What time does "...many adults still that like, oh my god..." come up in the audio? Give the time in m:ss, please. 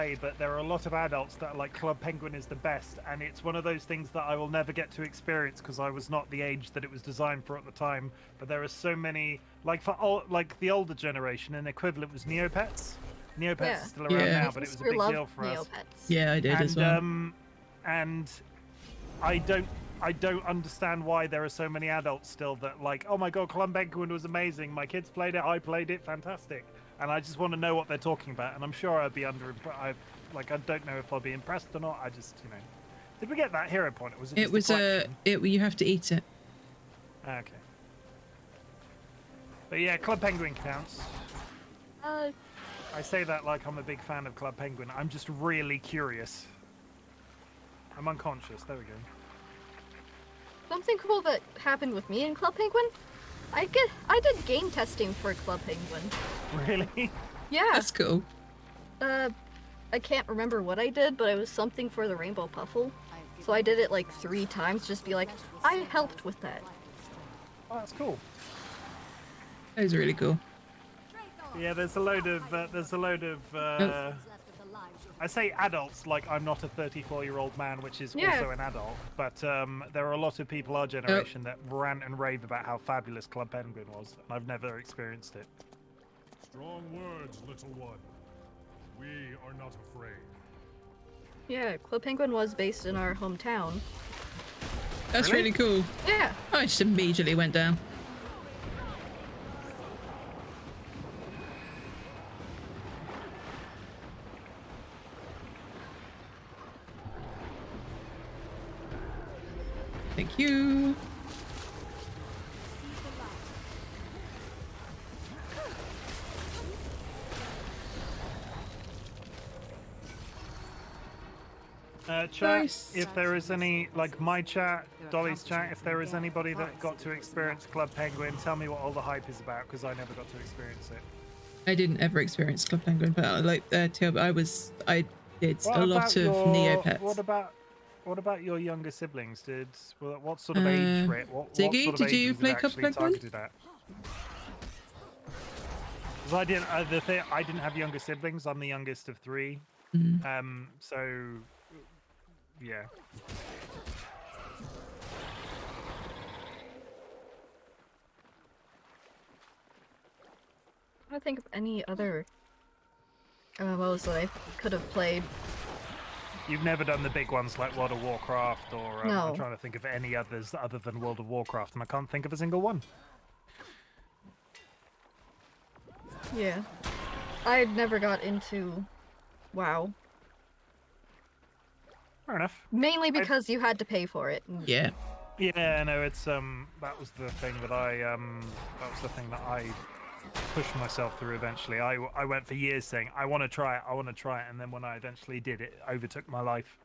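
0:21.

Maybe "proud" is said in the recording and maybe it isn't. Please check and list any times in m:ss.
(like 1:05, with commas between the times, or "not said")
not said.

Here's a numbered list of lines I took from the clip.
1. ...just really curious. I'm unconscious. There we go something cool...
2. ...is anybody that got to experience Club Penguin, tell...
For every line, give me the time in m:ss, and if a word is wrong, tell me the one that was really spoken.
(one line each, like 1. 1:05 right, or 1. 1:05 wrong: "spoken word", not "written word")
1. 0:45 right
2. 2:06 right.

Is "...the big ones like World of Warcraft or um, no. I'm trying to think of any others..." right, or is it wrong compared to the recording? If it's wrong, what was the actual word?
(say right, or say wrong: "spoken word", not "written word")
right.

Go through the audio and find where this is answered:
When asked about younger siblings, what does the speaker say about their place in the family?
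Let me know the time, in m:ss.
2:28.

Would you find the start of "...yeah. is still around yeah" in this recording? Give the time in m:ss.
0:13.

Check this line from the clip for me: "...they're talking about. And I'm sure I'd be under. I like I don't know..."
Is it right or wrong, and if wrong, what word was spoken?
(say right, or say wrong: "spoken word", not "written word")
right.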